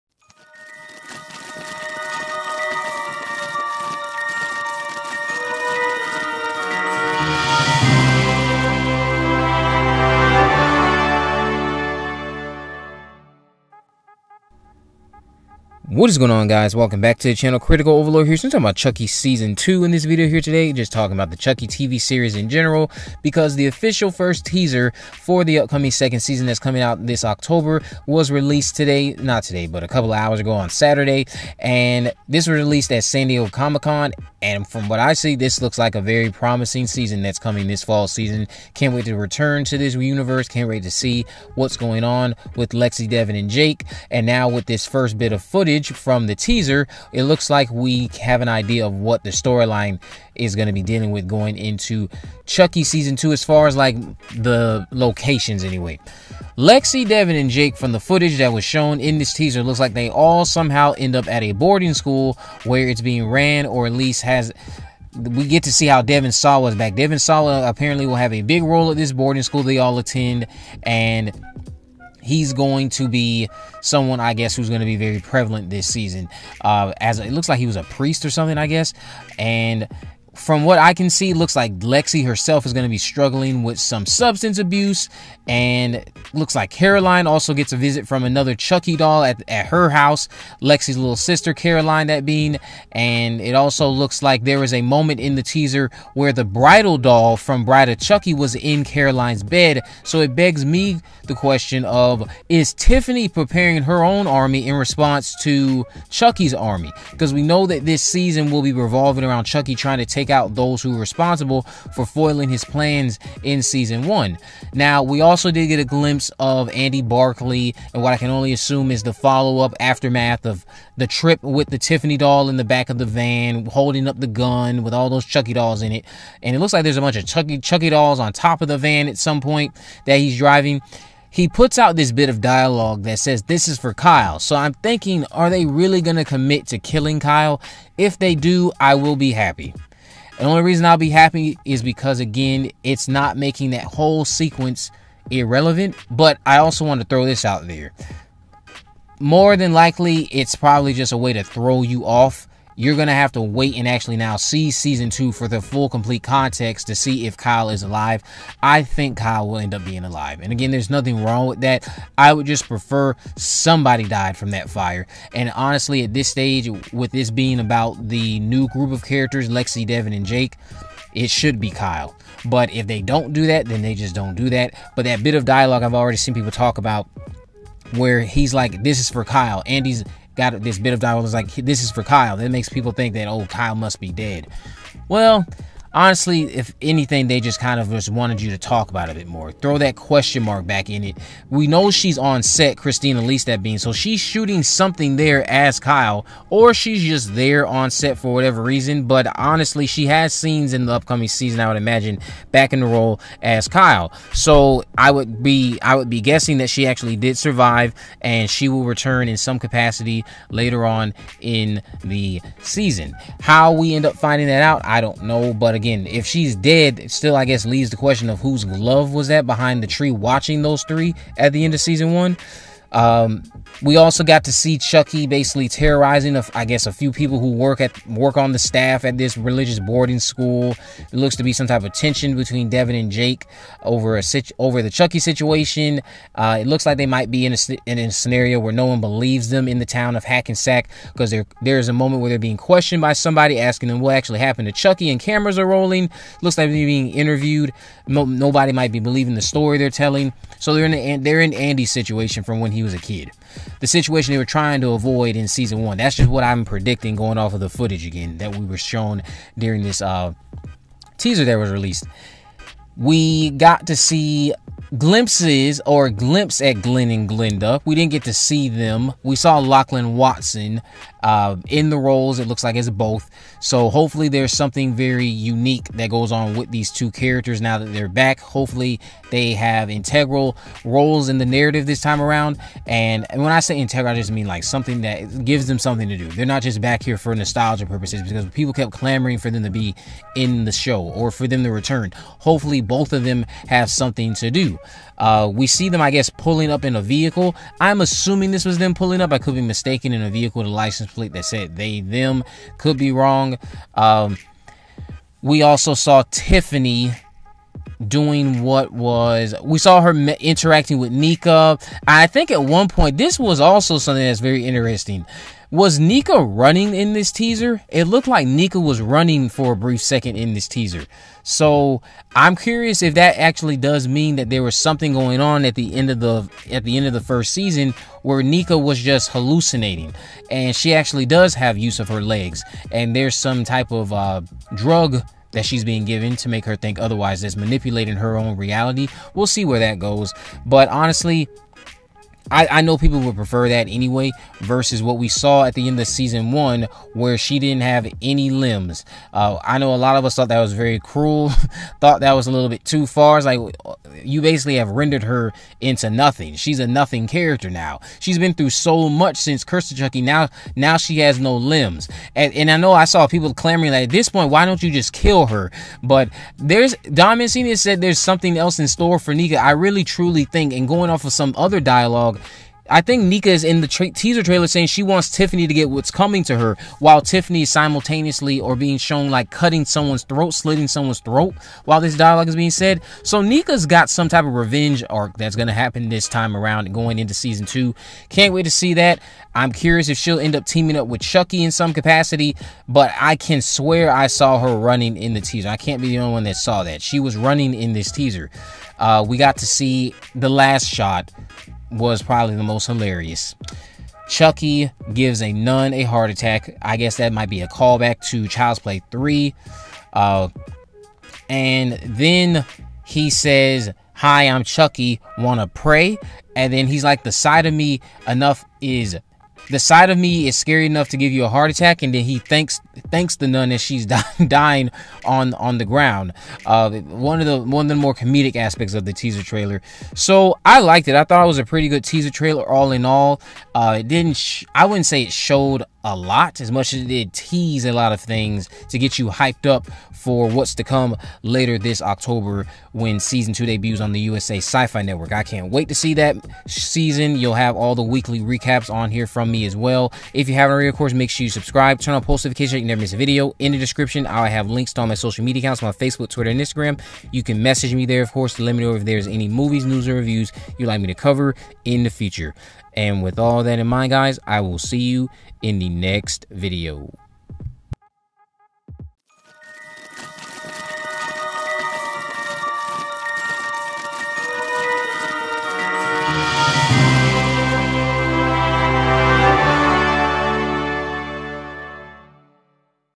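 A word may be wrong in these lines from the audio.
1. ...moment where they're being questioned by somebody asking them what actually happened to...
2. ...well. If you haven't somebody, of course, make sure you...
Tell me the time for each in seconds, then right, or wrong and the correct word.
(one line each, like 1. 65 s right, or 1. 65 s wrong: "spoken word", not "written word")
1. 241 s right
2. 449 s wrong: "already", not "somebody".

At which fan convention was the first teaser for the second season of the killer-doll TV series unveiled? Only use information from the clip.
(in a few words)
San Diego Comic-Con.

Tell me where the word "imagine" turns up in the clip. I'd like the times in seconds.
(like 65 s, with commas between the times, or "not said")
201 s.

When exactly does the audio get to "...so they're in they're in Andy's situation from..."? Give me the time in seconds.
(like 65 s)
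250 s.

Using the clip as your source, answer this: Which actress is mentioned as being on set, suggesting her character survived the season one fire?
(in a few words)
Christine Elise.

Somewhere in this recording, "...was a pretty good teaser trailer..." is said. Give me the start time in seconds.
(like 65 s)
431 s.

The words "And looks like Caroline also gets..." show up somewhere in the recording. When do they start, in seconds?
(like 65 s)
85 s.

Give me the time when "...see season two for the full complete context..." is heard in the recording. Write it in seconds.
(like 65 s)
154 s.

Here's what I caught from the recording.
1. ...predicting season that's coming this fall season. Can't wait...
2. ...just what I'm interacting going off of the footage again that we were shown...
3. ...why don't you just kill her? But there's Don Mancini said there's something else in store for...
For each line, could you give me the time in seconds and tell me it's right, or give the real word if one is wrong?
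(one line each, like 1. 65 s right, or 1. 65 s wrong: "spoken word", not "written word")
1. 36 s wrong: "promising", not "predicting"
2. 256 s wrong: "predicting", not "interacting"
3. 364 s right.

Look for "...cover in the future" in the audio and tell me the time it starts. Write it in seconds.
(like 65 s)
461 s.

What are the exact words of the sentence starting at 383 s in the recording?
So Nica's got some type of revenge arc that's going to happen this time around going into season two.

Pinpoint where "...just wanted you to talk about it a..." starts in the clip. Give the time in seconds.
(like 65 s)
187 s.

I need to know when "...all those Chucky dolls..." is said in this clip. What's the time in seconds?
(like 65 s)
124 s.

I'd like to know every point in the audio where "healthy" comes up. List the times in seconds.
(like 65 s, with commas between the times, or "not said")
not said.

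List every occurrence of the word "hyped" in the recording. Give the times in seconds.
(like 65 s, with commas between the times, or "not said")
439 s.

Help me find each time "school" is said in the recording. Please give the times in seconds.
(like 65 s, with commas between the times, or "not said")
61 s, 69 s, 230 s.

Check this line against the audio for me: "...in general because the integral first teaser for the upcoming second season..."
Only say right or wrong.
wrong.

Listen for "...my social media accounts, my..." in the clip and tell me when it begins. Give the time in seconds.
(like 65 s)
455 s.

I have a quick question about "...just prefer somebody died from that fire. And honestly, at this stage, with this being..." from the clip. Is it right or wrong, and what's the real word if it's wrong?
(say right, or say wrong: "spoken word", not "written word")
right.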